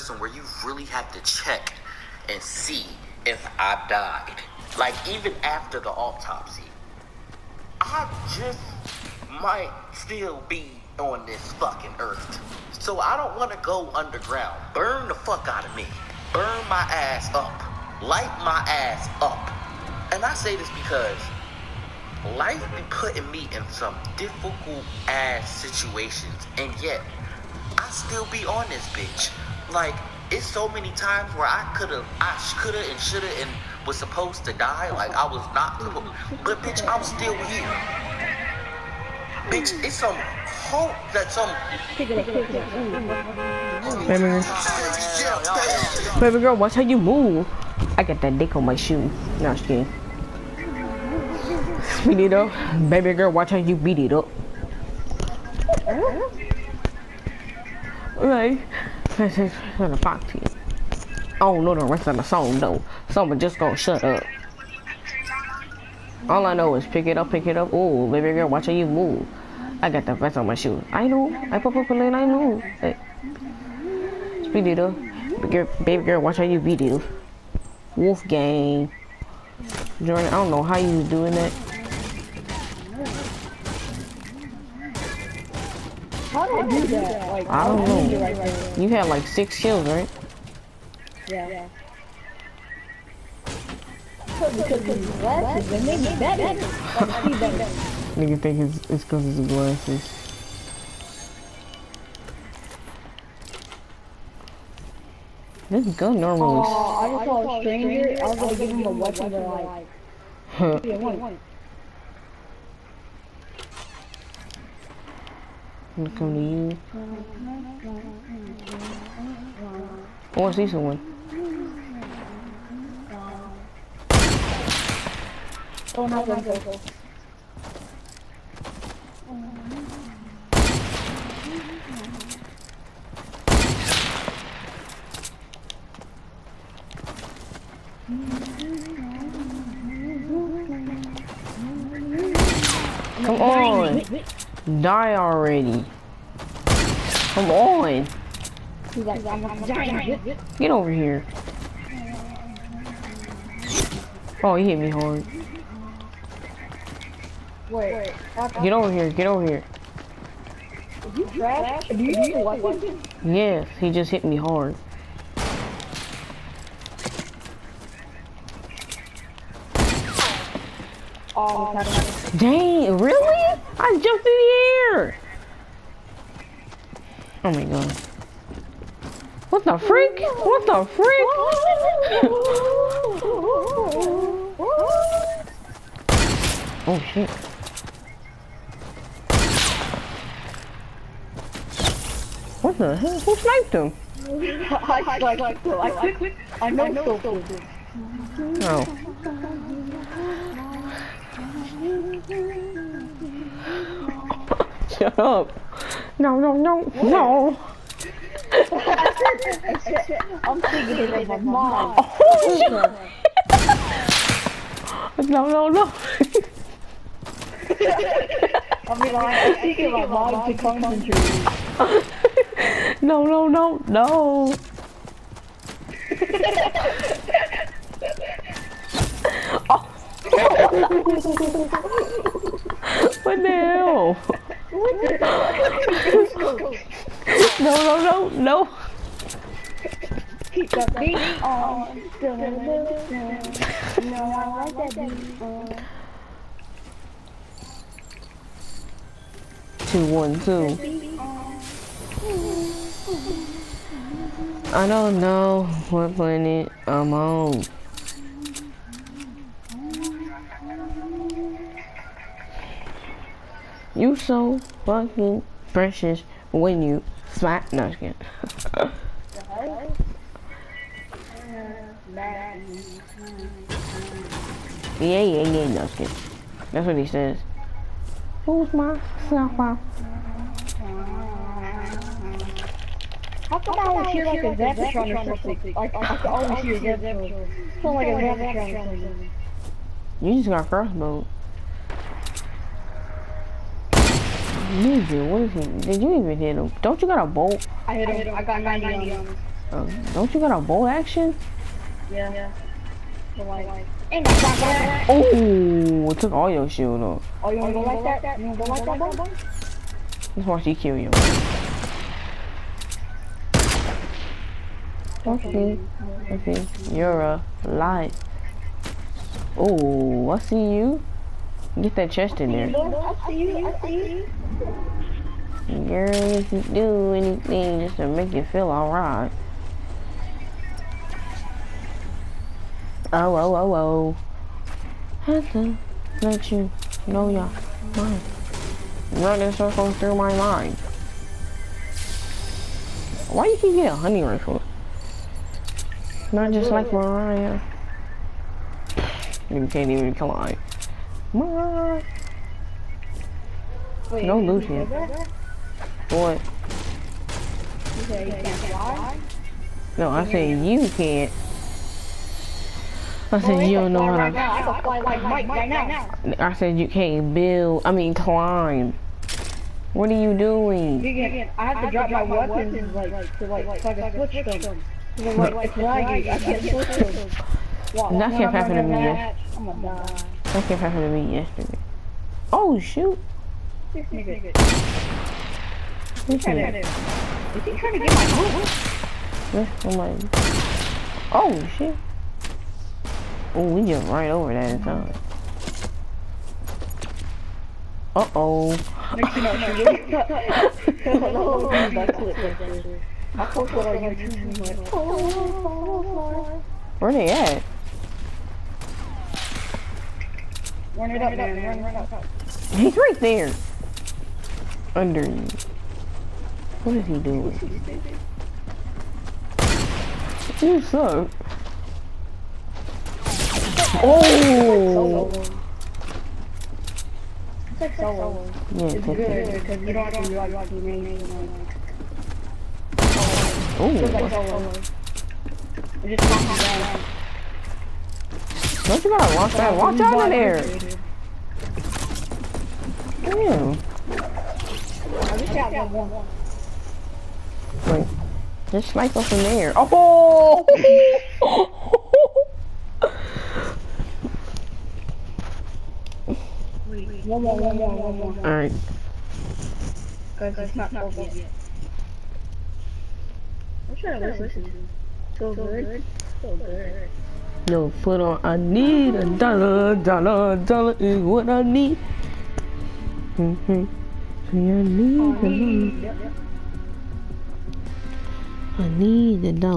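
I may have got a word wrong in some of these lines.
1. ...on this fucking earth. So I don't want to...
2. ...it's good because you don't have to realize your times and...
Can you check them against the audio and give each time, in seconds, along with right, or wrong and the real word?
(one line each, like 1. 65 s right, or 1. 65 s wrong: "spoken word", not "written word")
1. 10 s right
2. 428 s wrong: "teammates", not "times".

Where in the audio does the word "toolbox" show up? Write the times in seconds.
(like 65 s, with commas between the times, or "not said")
not said.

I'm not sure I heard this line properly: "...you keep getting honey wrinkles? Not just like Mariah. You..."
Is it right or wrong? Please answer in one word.
right.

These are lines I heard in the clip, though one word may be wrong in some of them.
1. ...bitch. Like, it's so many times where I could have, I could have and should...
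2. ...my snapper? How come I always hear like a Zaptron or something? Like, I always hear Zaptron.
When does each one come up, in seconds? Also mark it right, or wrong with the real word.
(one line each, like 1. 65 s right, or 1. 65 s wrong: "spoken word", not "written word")
1. 28 s right
2. 278 s right.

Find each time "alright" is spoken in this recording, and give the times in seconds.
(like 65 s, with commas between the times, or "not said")
328 s, 458 s.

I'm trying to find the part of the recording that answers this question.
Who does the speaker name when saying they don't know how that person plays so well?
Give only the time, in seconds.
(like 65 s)
80 s.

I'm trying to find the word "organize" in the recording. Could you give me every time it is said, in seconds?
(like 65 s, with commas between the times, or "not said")
not said.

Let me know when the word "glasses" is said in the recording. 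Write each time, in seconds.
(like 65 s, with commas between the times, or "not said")
99 s.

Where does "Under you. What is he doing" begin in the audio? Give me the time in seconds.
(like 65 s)
414 s.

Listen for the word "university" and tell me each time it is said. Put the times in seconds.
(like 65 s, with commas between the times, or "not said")
not said.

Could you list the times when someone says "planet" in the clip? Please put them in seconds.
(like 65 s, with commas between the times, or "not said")
256 s.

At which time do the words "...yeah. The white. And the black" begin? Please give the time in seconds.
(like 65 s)
302 s.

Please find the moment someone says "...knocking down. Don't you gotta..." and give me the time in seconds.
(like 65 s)
436 s.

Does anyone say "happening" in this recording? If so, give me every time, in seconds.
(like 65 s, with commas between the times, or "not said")
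378 s.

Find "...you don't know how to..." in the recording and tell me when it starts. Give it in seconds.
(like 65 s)
363 s.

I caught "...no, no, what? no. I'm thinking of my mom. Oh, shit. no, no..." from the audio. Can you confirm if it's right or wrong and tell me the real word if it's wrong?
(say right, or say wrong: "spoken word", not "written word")
right.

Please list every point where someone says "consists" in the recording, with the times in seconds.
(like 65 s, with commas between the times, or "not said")
not said.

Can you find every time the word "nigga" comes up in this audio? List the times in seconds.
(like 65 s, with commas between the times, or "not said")
98 s, 384 s.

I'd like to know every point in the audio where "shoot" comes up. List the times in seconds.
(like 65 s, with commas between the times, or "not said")
382 s.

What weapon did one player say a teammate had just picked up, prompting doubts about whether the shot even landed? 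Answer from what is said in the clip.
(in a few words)
Crossbow.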